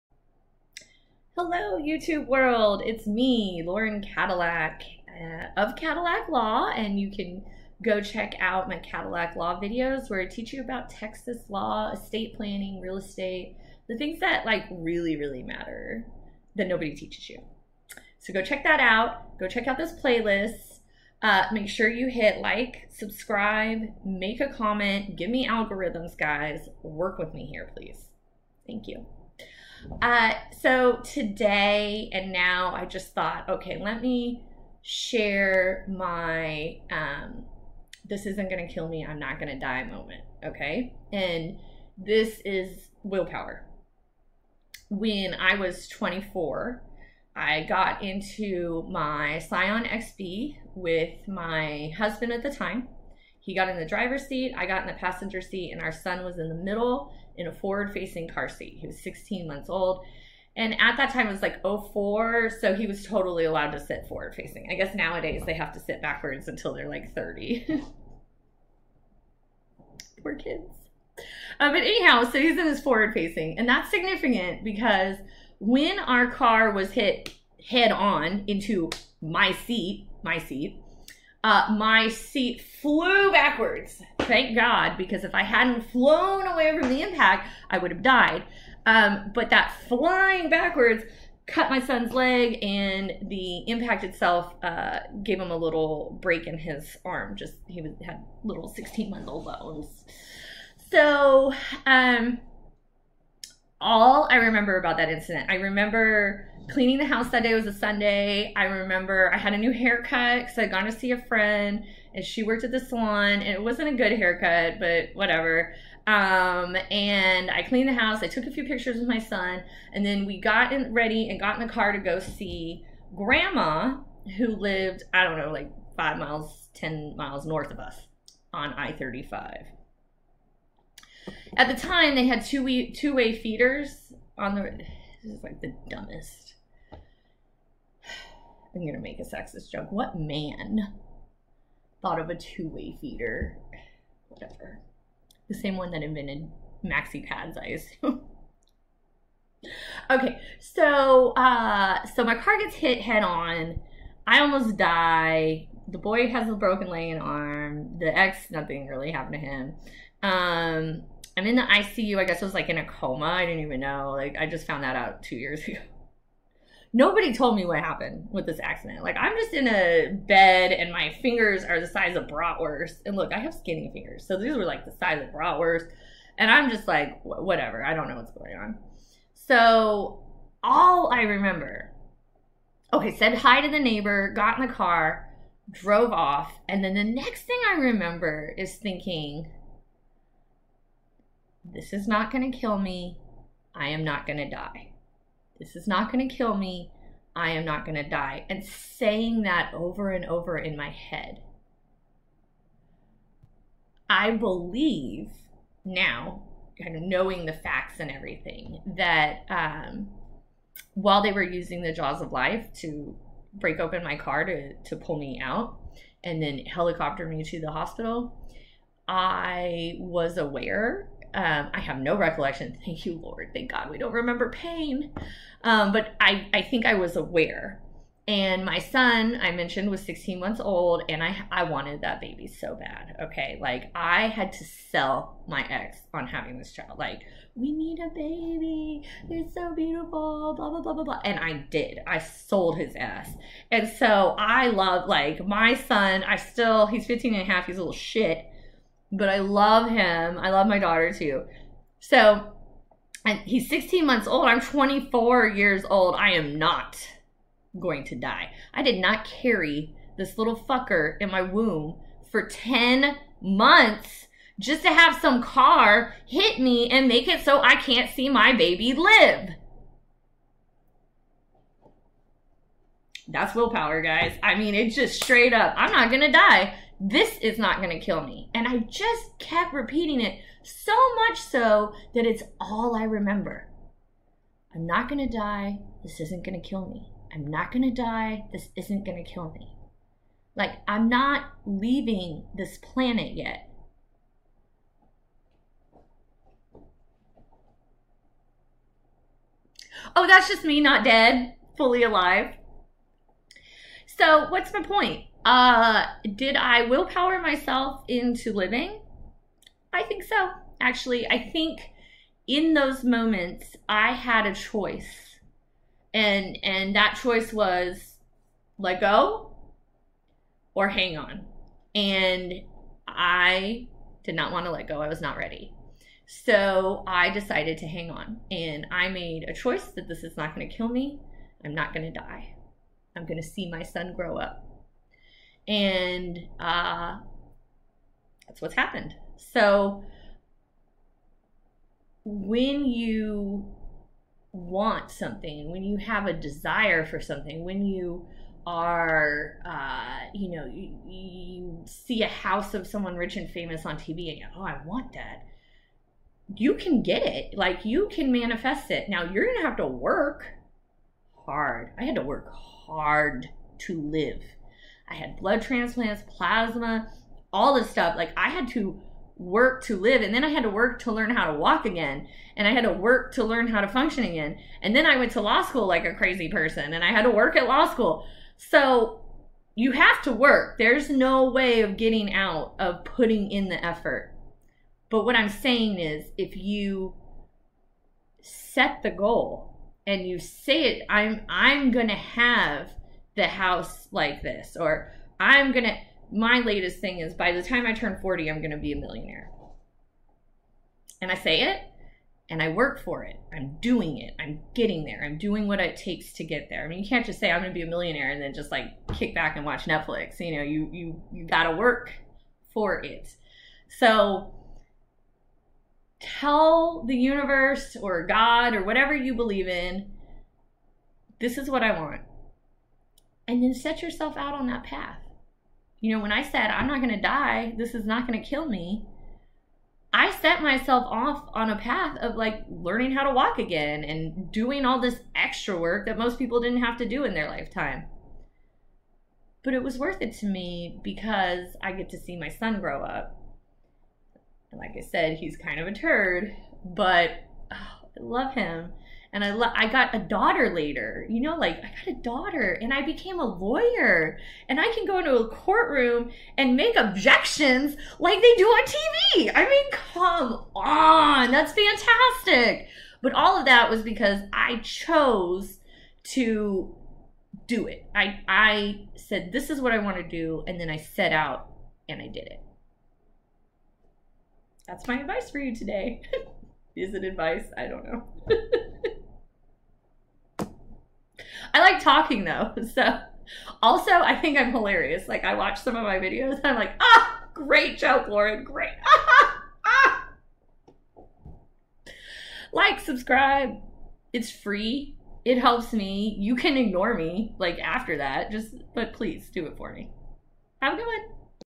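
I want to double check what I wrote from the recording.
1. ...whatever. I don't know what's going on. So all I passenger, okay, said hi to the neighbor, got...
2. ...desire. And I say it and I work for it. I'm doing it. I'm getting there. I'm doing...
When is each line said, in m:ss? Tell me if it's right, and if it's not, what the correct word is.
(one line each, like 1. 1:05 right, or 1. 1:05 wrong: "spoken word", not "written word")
1. 2:57 wrong: "remember", not "passenger"
2. 6:38 wrong: "millionaire", not "desire".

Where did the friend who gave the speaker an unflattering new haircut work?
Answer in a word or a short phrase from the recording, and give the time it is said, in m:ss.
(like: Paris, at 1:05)
The salon, at 1:52.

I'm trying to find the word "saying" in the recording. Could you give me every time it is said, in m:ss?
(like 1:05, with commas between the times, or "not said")
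3:18, 6:25.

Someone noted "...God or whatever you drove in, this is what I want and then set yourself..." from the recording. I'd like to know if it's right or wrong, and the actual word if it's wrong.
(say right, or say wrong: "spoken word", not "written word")
wrong: "believe", not "drove".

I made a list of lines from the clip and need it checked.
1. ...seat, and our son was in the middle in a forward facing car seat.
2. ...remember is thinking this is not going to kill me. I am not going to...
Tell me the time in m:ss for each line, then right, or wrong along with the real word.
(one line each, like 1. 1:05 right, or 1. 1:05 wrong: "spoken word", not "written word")
1. 0:55 right
2. 3:07 right.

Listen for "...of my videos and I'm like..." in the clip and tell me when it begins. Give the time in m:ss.
8:05.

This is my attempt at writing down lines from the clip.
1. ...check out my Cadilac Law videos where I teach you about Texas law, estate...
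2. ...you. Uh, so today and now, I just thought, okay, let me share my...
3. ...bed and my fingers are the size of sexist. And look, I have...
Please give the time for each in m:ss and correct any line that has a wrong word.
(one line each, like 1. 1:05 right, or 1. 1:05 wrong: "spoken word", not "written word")
1. 0:08 right
2. 0:28 right
3. 2:50 wrong: "bratwurst", not "sexist".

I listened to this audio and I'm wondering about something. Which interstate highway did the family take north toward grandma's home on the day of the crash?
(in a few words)
I-35.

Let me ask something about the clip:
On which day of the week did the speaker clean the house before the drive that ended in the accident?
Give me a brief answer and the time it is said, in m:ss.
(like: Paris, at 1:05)
Sunday, at 1:47.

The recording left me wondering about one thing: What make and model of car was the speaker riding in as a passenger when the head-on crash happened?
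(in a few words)
Scion XB.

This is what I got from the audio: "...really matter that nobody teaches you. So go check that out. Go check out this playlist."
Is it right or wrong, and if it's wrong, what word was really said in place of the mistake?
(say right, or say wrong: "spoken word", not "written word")
right.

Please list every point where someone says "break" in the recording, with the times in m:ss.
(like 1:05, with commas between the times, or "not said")
1:36, 3:33.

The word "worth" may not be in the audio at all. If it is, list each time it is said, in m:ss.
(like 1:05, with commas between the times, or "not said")
7:19.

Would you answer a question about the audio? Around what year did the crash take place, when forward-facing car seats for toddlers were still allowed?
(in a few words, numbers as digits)
2004.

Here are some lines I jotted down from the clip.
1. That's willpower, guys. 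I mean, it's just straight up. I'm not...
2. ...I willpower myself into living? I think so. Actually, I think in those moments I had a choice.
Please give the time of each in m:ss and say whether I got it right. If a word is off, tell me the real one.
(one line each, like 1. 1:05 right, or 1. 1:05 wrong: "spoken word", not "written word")
1. 4:33 right
2. 5:06 right.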